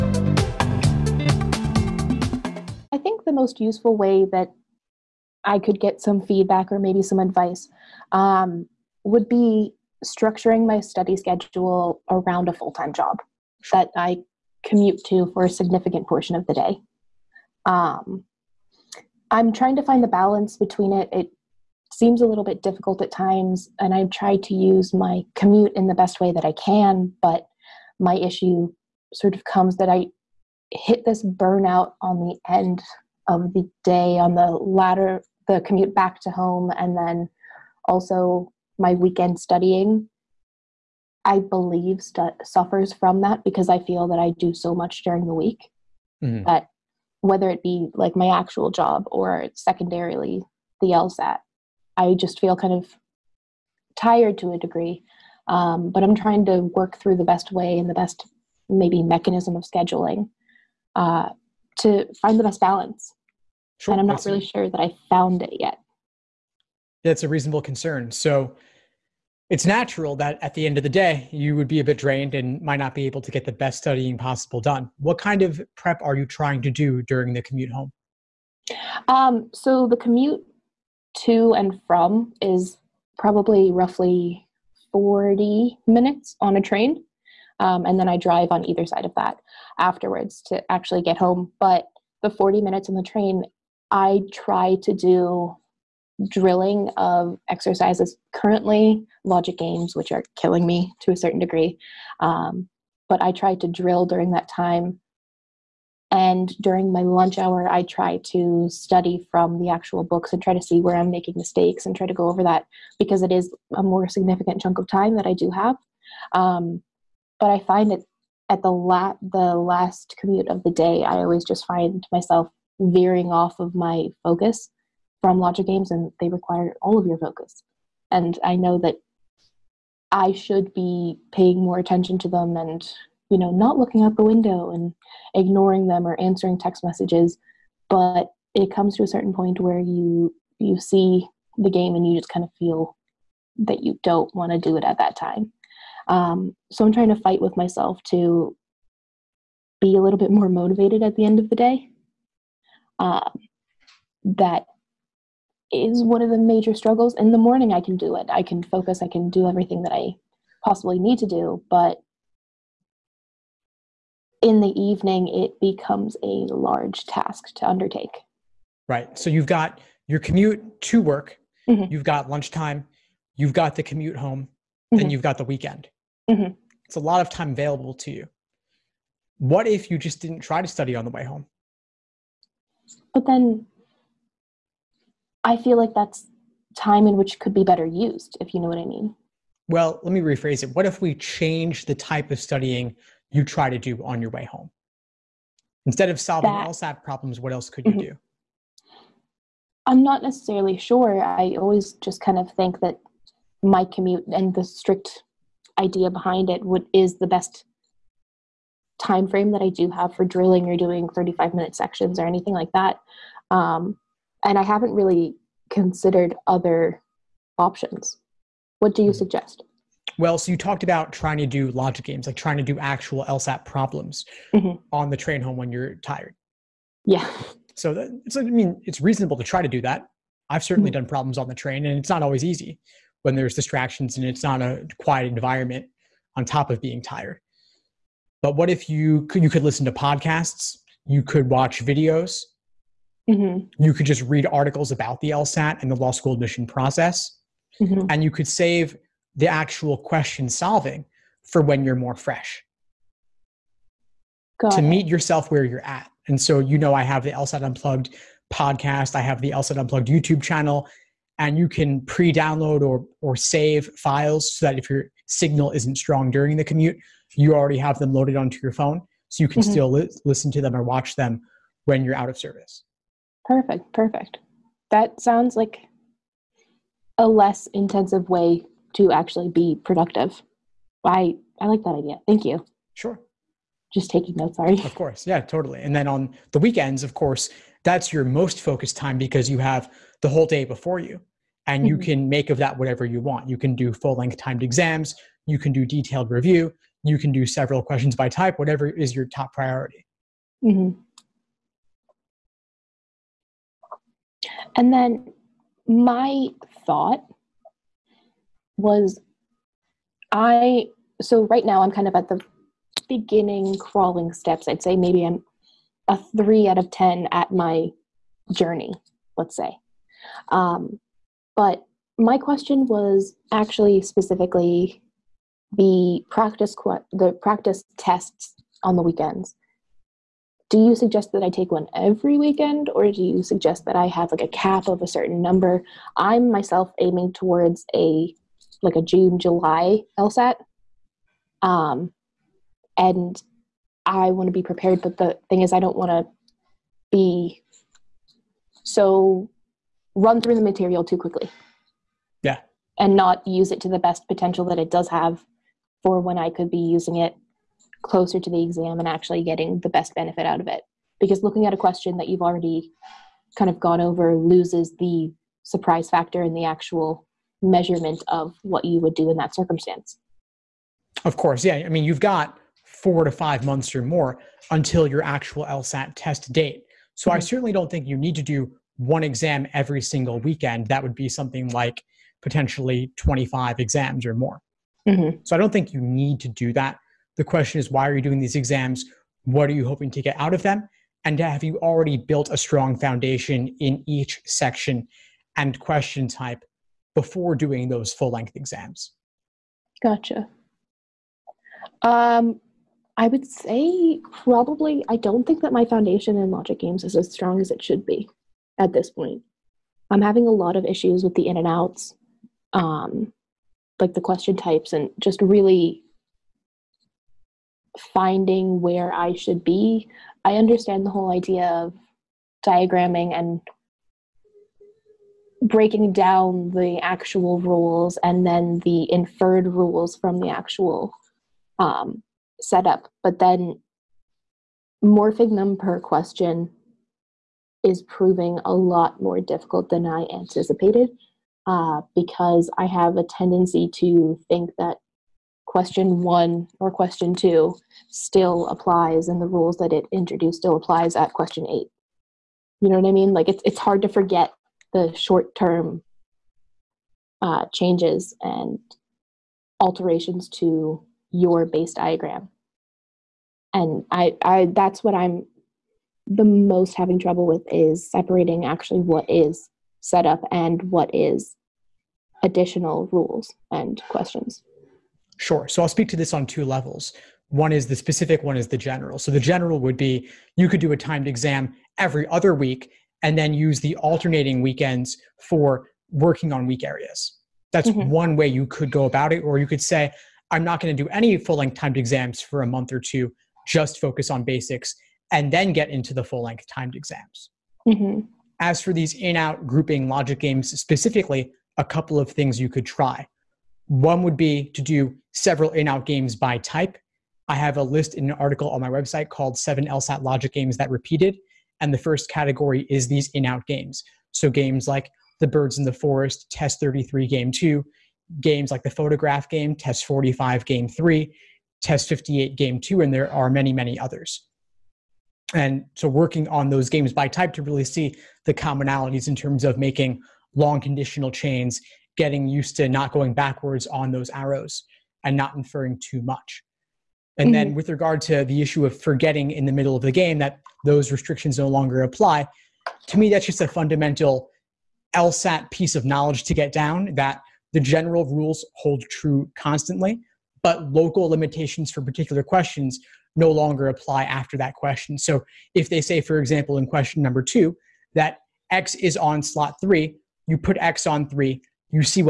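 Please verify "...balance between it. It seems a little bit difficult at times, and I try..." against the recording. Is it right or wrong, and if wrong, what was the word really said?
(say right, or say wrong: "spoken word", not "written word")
right.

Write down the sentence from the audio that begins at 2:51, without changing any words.
you've got lunchtime, you've got the commute home, mm-hmm.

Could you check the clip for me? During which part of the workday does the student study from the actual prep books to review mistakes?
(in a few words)
lunch hour.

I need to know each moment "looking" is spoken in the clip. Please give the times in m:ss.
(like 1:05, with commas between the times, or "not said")
2:13, 6:01.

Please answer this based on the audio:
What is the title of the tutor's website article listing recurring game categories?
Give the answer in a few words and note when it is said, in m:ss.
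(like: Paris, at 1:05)
Seven LSAT Logic Games That Repeated, at 8:29.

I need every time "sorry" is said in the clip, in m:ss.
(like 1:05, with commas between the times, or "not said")
4:44.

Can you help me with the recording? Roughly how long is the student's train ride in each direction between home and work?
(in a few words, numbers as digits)
40 minutes.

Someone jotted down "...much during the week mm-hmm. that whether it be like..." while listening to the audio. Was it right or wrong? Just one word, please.
right.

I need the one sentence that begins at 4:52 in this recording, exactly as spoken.
can make of that whatever you want.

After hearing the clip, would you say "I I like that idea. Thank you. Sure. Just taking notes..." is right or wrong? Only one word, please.
right.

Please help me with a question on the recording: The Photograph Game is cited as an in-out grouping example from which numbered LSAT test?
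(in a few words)
Test 45.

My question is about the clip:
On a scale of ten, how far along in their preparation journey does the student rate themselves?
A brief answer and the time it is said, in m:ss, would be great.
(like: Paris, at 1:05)
3, at 5:16.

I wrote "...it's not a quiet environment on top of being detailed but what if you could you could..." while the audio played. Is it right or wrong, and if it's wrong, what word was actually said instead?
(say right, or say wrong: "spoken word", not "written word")
wrong: "tired", not "detailed".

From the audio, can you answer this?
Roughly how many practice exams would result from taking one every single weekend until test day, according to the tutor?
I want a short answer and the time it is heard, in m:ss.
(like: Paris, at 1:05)
25, at 6:23.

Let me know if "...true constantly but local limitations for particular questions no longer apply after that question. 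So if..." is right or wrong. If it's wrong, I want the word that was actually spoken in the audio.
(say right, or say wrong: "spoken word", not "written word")
right.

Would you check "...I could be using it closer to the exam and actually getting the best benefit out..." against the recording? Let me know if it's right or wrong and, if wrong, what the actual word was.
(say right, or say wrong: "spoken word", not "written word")
right.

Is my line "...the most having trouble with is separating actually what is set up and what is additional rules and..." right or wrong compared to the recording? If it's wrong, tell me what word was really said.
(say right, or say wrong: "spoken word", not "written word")
right.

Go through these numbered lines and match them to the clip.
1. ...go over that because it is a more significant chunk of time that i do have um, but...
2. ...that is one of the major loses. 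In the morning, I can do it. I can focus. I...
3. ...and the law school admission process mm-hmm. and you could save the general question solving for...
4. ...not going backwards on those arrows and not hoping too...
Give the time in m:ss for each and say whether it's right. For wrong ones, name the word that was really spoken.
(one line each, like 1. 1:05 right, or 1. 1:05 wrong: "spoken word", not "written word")
1. 1:52 right
2. 2:34 wrong: "struggles", not "loses"
3. 4:05 wrong: "actual", not "general"
4. 8:52 wrong: "inferring", not "hoping".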